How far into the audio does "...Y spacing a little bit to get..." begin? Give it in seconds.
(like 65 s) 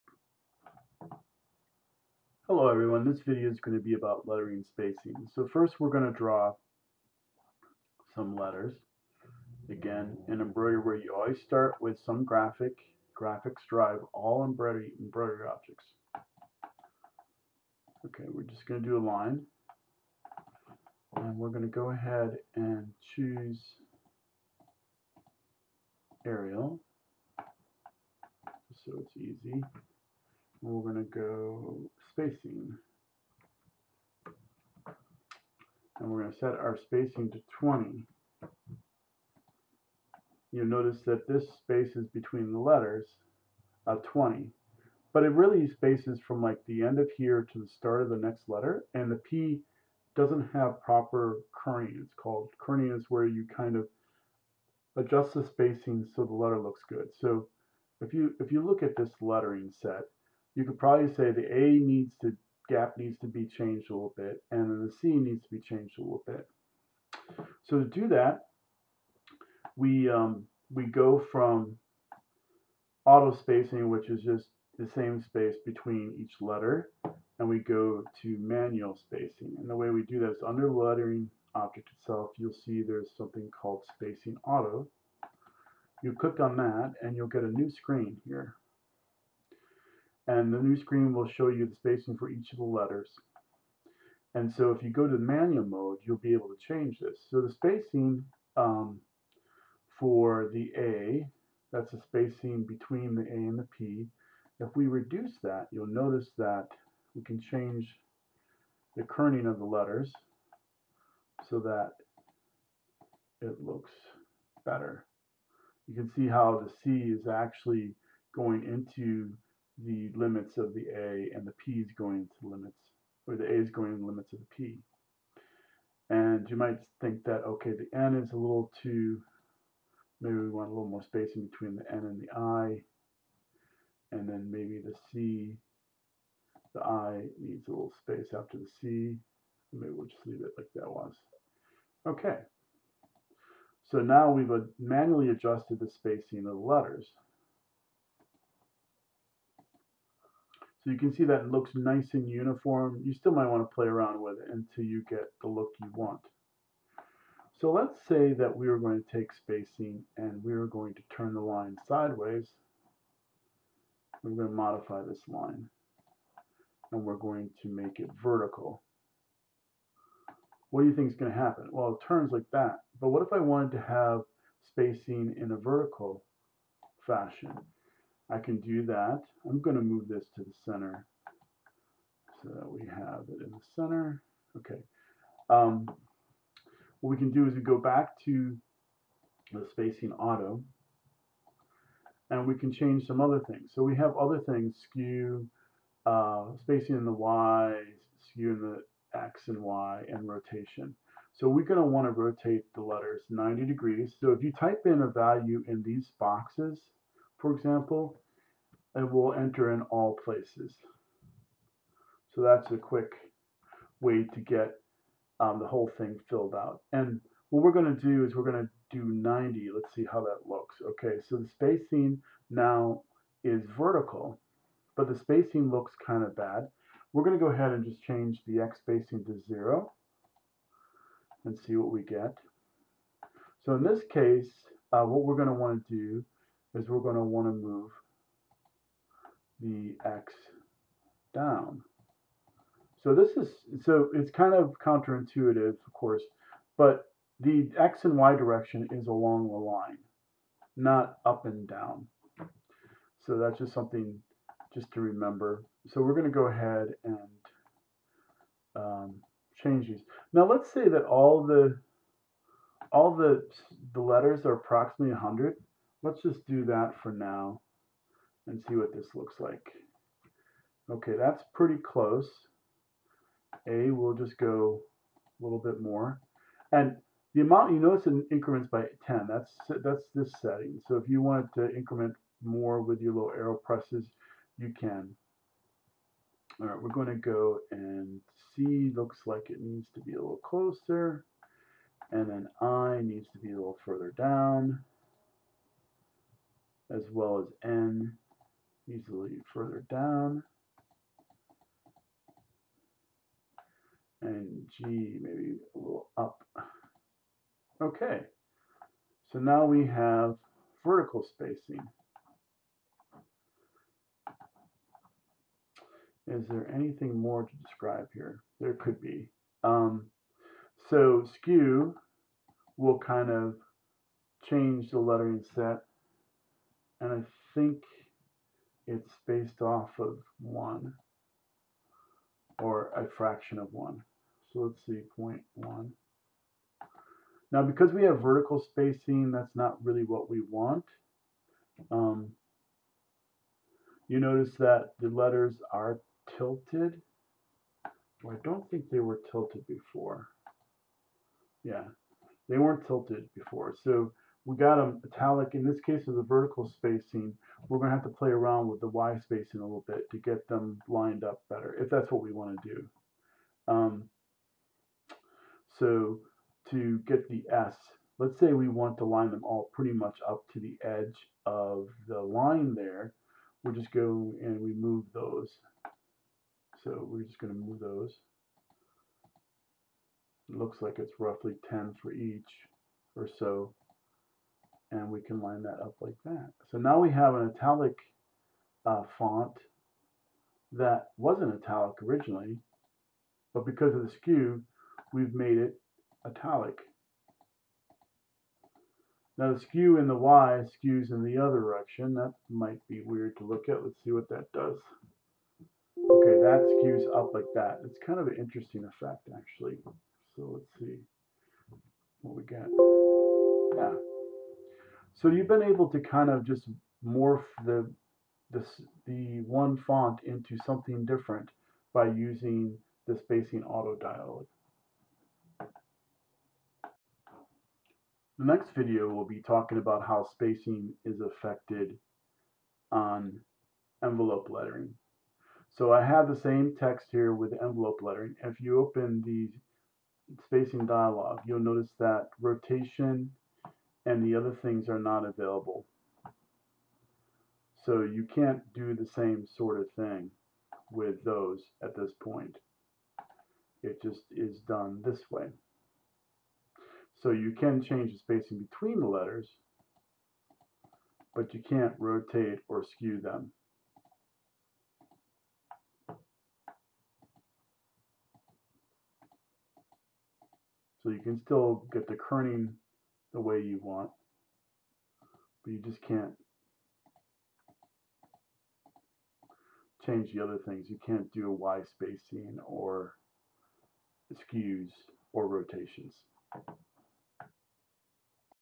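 358 s.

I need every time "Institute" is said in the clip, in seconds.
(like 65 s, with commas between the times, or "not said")
not said.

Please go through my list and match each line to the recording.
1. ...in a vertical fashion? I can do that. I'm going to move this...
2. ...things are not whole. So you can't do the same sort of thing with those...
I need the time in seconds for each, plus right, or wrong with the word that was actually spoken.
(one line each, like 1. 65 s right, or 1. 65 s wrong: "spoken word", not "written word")
1. 175 s right
2. 444 s wrong: "available", not "whole".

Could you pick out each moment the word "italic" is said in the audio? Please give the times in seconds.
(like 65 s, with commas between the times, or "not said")
355 s, 387 s, 391 s, 396 s.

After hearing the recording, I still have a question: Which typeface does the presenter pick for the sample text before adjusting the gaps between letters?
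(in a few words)
Arial.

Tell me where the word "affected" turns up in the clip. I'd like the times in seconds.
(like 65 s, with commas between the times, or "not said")
431 s.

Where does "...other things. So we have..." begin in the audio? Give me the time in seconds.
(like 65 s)
193 s.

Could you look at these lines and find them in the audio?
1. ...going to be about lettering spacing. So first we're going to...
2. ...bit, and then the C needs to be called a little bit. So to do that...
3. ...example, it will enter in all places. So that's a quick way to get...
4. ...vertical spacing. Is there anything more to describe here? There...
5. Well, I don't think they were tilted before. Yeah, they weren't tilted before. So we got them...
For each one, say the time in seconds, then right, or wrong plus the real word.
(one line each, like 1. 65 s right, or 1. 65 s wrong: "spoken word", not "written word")
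1. 3 s right
2. 64 s wrong: "changed", not "called"
3. 207 s right
4. 310 s right
5. 348 s right.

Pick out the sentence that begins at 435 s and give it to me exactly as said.
So I have the same text here with envelope lettering.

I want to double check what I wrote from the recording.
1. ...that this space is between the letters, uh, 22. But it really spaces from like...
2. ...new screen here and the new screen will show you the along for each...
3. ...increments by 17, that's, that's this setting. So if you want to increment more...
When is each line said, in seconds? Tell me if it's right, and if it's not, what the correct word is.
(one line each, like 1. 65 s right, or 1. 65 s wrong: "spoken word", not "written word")
1. 41 s wrong: "20", not "22"
2. 87 s wrong: "spacing", not "along"
3. 278 s wrong: "10", not "17".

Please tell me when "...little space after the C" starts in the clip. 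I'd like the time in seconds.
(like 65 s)
137 s.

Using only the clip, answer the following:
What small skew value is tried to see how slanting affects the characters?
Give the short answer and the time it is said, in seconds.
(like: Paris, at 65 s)
0.1, at 335 s.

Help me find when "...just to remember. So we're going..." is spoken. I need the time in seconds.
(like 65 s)
254 s.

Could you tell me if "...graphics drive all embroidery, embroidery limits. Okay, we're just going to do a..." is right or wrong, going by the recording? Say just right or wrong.
wrong.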